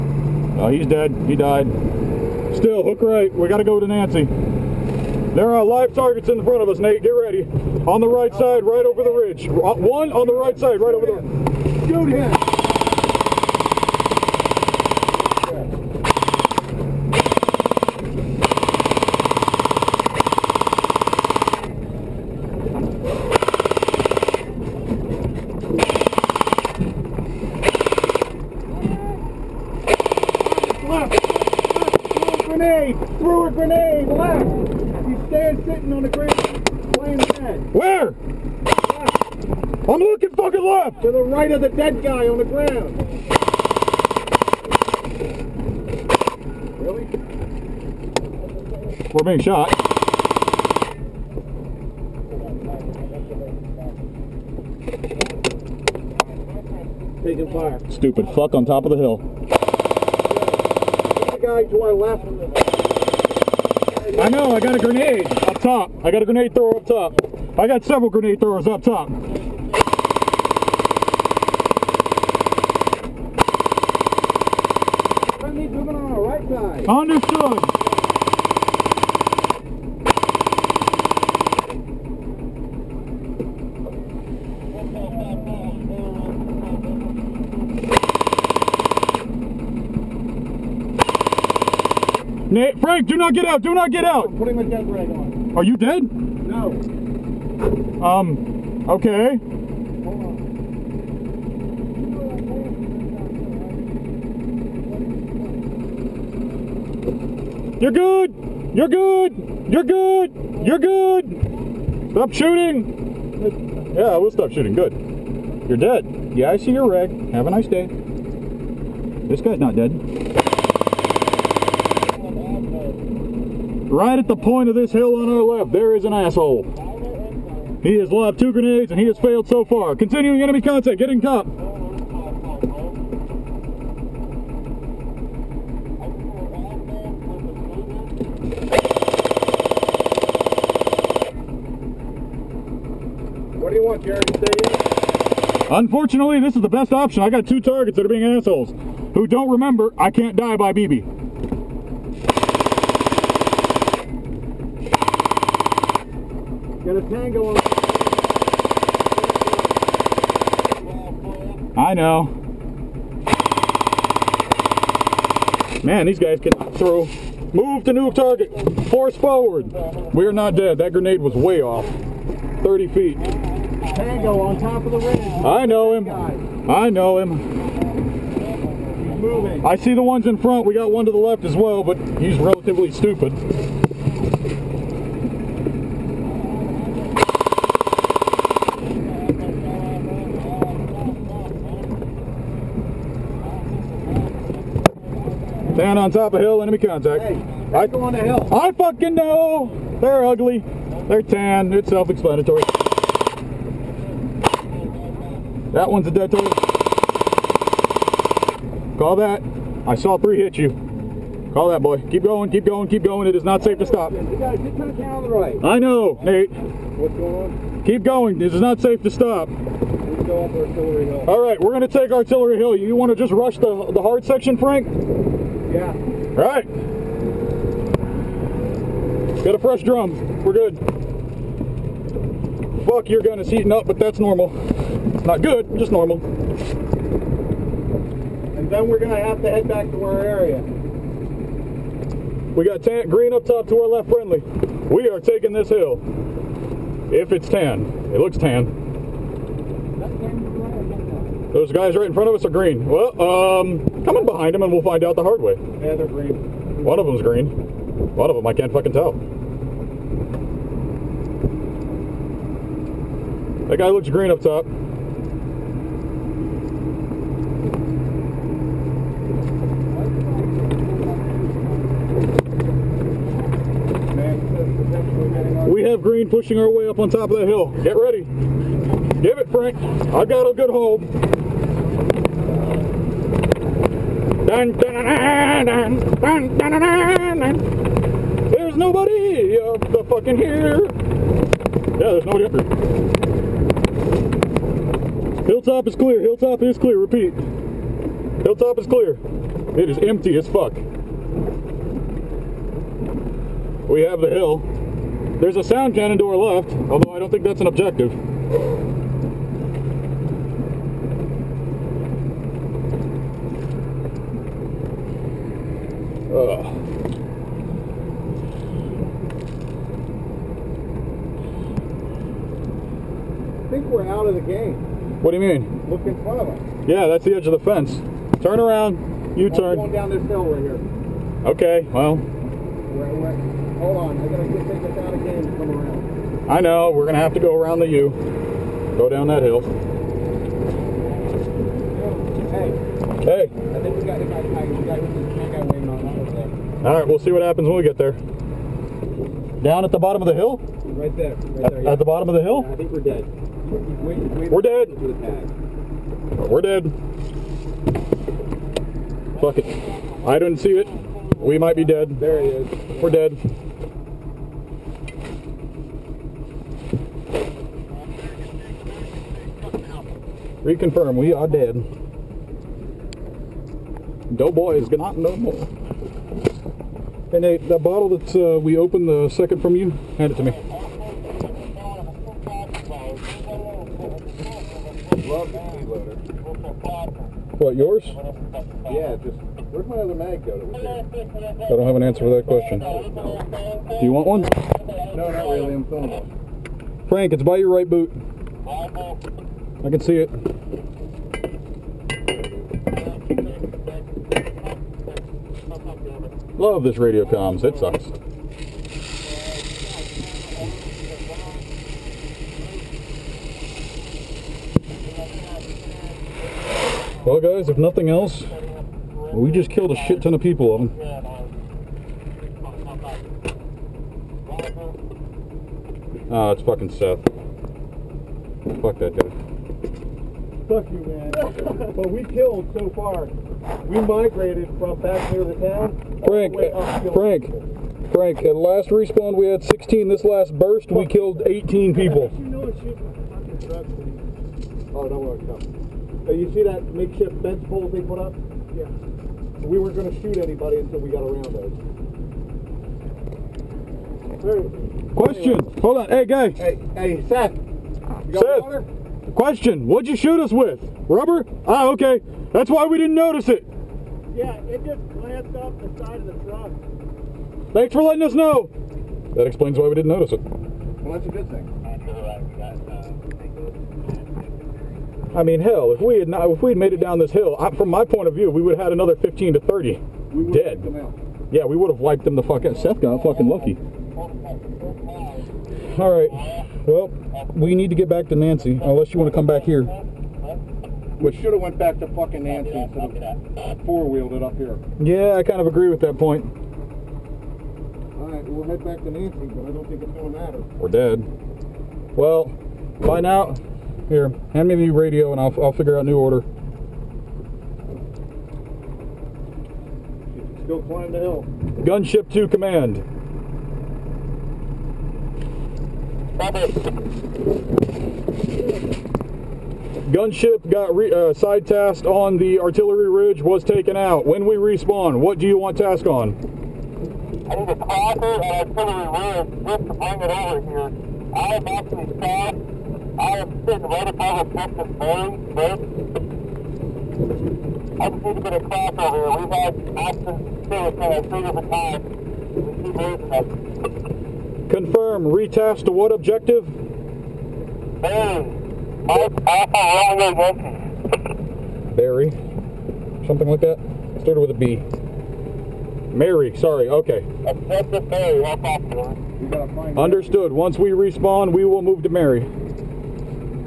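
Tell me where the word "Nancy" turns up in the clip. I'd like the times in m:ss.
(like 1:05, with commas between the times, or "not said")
0:03, 8:08, 8:12, 8:19.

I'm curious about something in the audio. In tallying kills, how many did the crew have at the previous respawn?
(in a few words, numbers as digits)
16.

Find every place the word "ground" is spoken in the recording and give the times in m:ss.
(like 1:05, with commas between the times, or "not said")
0:42.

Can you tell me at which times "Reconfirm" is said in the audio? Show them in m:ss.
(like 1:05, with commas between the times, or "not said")
6:10.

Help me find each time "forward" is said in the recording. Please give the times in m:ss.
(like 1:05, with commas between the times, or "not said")
2:49.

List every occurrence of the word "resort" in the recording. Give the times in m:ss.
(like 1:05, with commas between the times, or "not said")
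not said.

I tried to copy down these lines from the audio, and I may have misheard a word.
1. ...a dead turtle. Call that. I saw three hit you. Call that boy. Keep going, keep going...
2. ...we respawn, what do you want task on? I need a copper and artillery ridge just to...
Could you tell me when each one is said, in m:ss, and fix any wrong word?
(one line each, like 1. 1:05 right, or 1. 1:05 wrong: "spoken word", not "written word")
1. 3:26 right
2. 8:44 right.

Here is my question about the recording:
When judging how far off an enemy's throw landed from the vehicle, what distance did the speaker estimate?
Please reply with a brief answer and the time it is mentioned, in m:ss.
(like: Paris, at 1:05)
30 feet, at 2:52.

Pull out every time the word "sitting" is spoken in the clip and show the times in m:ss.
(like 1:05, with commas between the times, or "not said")
8:53.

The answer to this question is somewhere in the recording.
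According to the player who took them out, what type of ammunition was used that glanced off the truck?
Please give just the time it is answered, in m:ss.
7:41.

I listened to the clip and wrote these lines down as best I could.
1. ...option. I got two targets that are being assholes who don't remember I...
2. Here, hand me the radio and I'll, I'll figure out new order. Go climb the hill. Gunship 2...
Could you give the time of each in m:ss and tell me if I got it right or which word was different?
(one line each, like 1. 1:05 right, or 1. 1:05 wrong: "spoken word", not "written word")
1. 2:26 right
2. 8:24 right.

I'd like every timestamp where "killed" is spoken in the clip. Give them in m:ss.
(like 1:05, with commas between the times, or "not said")
6:59, 7:12, 7:21.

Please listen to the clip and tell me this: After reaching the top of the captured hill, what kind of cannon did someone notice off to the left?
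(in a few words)
Sound cannon.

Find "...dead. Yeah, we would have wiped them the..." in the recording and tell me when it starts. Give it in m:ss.
8:00.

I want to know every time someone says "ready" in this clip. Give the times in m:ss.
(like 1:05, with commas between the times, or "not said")
0:07, 4:37.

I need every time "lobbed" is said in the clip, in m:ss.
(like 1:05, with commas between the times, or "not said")
2:08.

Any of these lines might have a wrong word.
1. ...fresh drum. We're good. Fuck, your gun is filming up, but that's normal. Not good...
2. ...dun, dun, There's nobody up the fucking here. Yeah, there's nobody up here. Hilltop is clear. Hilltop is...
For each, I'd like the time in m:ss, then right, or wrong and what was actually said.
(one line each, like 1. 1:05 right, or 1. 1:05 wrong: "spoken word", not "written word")
1. 3:49 wrong: "heating", not "filming"
2. 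4:46 right.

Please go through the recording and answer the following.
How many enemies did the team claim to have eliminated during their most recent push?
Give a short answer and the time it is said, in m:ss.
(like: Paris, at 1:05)
18, at 7:21.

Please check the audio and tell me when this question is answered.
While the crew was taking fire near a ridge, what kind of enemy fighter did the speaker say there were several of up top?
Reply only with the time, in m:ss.
1:08.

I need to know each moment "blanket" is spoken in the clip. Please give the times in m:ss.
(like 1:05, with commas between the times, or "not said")
not said.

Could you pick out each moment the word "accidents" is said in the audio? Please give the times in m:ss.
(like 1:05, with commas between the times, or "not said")
8:59.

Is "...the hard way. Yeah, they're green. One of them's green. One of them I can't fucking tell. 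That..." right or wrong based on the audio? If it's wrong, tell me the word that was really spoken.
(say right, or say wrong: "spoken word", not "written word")
right.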